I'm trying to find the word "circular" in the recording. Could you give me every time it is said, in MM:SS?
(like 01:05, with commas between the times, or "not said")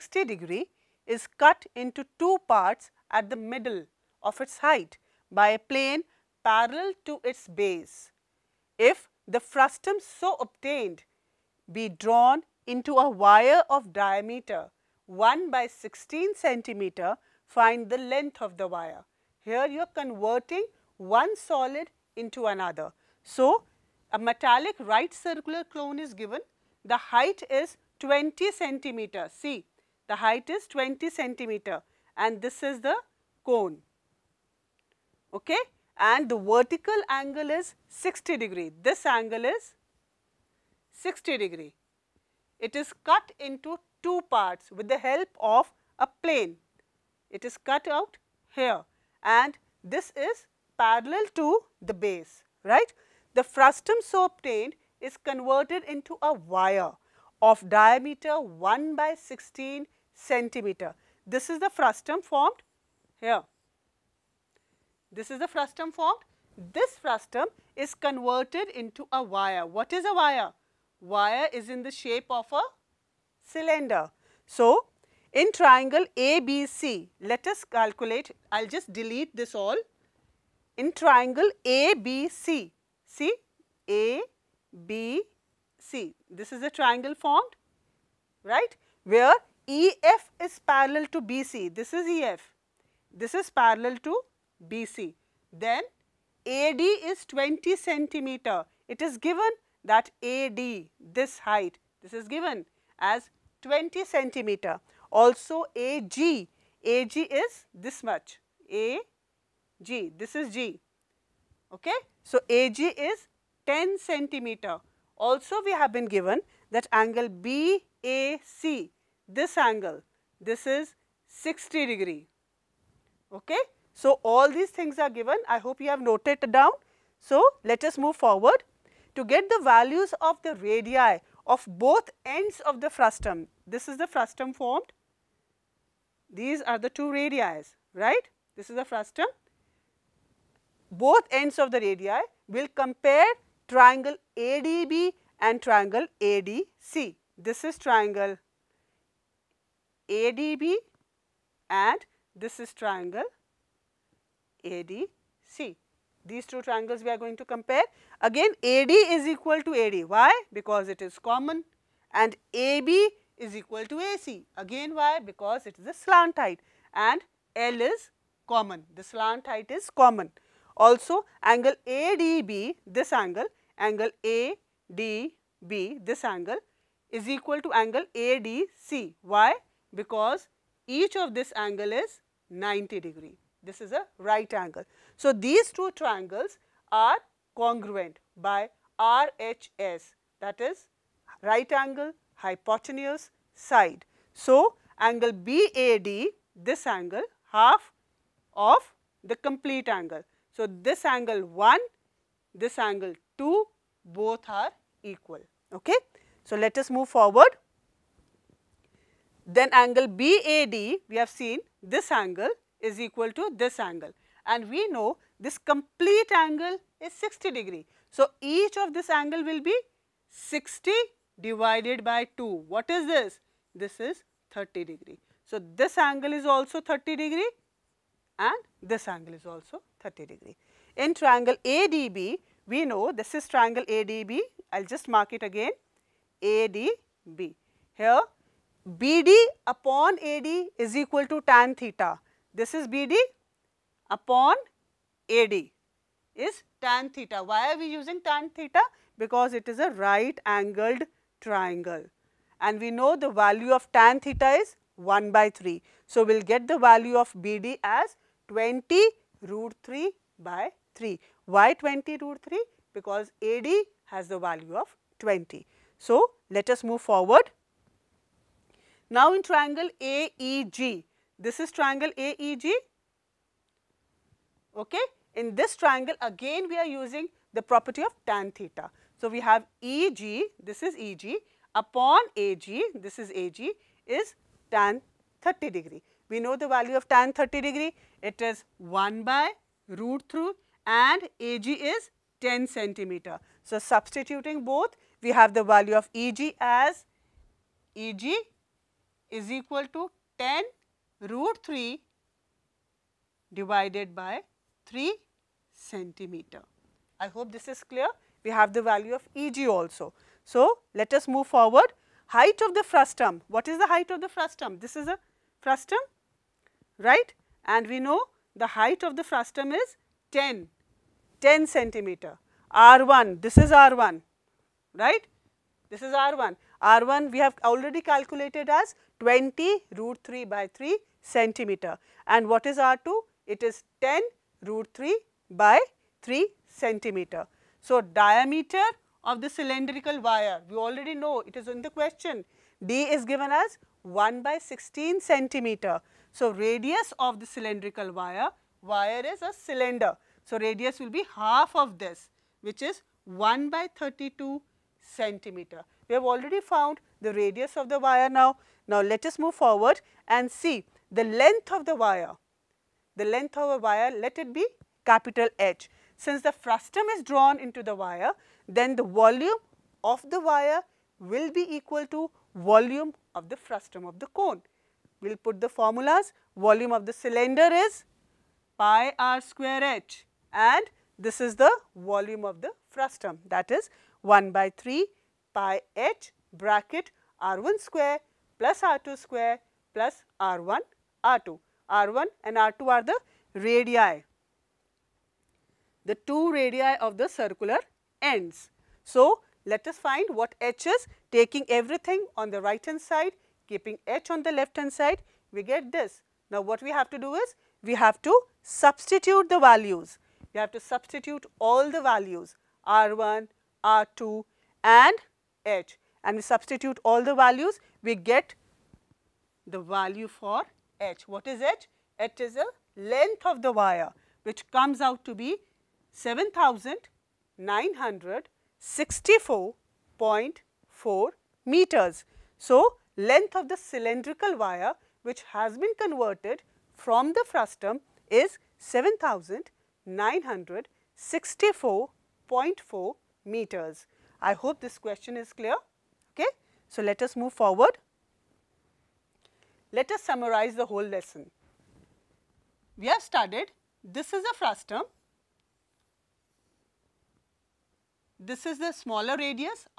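00:25, 06:37.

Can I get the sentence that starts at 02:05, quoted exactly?
I hope you have noted down.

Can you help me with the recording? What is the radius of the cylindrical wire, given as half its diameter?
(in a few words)
1/32 cm.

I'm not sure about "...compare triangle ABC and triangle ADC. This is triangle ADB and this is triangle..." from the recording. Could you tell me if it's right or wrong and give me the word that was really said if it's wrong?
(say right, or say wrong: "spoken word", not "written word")
wrong: "ADB", not "ABC".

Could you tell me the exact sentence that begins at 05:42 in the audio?
D is given as 1 by 16 centimeter.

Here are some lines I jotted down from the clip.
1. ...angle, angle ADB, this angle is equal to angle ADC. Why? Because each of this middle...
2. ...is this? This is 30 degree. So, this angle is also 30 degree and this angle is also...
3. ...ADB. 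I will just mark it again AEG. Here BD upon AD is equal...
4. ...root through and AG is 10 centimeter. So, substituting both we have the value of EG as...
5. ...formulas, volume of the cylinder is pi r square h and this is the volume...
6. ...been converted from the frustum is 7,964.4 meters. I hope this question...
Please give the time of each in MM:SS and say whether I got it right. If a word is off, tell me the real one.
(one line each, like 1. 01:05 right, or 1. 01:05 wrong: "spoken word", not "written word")
1. 02:53 wrong: "angle", not "middle"
2. 03:42 right
3. 03:53 wrong: "ADB", not "AEG"
4. 04:49 right
5. 06:15 right
6. 07:15 right.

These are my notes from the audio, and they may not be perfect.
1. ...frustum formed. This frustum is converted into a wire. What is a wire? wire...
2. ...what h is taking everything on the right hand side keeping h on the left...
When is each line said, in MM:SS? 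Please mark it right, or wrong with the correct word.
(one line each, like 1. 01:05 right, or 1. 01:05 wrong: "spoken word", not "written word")
1. 01:05 right
2. 06:40 right.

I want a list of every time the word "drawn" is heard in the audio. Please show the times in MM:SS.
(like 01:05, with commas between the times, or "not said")
00:11, 06:07.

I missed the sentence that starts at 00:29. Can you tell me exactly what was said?
See, the height is 20 centimeter and this is the cone.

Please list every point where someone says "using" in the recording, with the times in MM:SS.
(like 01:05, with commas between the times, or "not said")
04:07, 04:36.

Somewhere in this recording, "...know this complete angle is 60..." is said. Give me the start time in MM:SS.
03:34.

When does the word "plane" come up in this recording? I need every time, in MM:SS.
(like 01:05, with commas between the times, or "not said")
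00:05, 00:46.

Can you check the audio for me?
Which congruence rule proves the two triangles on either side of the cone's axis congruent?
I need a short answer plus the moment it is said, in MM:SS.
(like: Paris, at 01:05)
RHS, at 03:08.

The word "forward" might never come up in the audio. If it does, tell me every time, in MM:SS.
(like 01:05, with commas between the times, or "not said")
02:08, 03:27, 04:27, 05:11, 05:59, 07:27.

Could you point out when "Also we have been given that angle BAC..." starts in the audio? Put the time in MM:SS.
01:55.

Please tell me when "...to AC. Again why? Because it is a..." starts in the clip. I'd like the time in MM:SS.
02:43.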